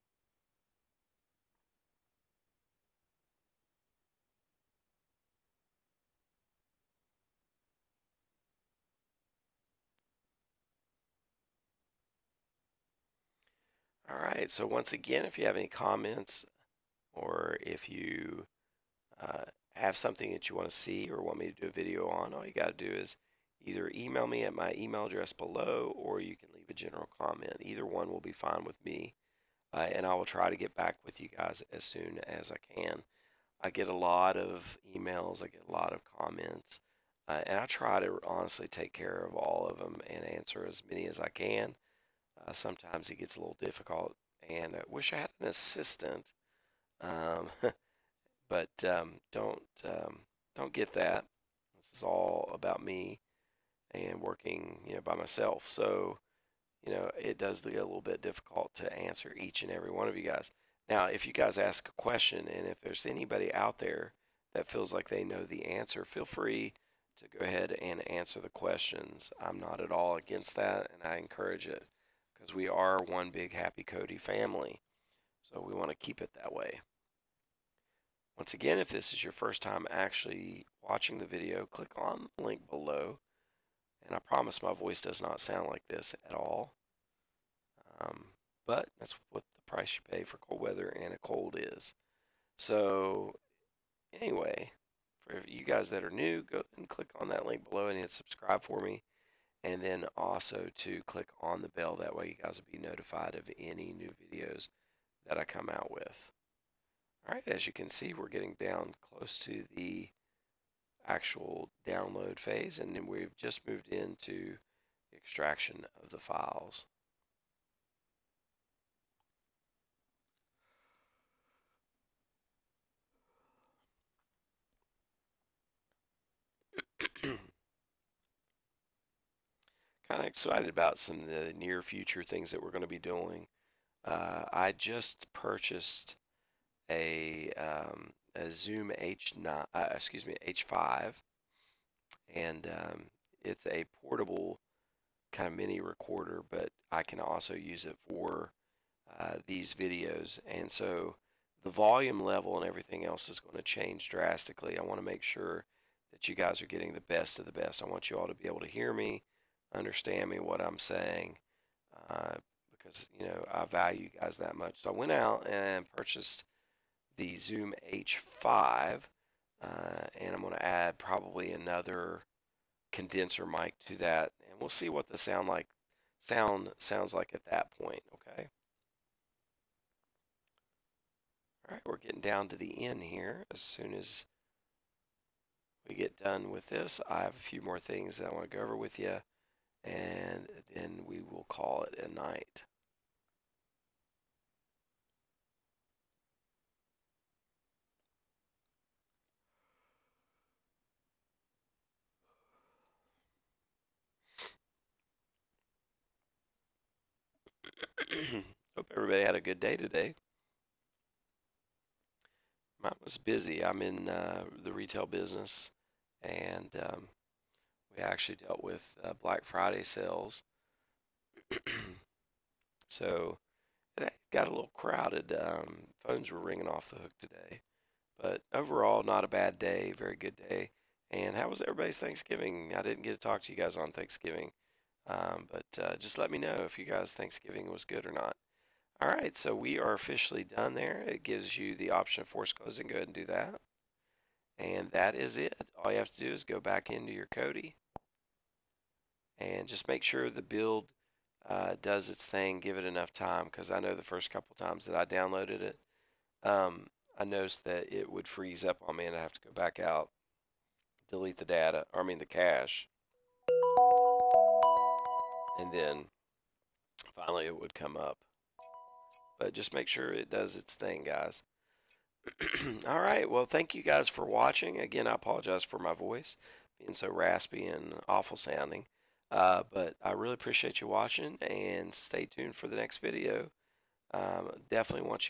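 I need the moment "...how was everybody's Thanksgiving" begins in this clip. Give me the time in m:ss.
3:51.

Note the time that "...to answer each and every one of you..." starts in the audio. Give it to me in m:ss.
0:58.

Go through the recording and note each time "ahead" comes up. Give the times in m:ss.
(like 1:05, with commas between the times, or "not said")
1:07, 4:02.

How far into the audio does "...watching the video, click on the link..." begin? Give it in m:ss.
1:20.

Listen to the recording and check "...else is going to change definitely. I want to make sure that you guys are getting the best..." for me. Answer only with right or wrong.
wrong.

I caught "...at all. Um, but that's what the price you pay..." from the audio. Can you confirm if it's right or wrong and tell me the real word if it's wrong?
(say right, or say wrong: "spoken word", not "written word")
right.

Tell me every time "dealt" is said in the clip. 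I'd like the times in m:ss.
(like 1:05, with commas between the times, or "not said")
3:38.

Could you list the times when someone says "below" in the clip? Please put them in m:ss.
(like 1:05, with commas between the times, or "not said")
0:25, 1:22, 1:37.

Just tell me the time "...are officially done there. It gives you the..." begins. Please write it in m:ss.
3:59.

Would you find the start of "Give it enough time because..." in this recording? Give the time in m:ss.
4:12.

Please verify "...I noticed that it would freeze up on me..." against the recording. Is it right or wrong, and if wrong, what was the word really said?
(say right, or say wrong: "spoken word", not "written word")
right.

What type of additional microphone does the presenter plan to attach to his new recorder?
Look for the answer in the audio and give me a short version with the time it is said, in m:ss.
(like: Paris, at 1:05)
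condenser mic, at 2:52.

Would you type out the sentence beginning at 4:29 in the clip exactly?
But just make sure it does its thing, guys.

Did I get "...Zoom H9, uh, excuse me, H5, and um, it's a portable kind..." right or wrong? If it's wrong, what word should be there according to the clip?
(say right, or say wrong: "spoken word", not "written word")
right.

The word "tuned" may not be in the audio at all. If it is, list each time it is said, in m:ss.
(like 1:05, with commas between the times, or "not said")
4:42.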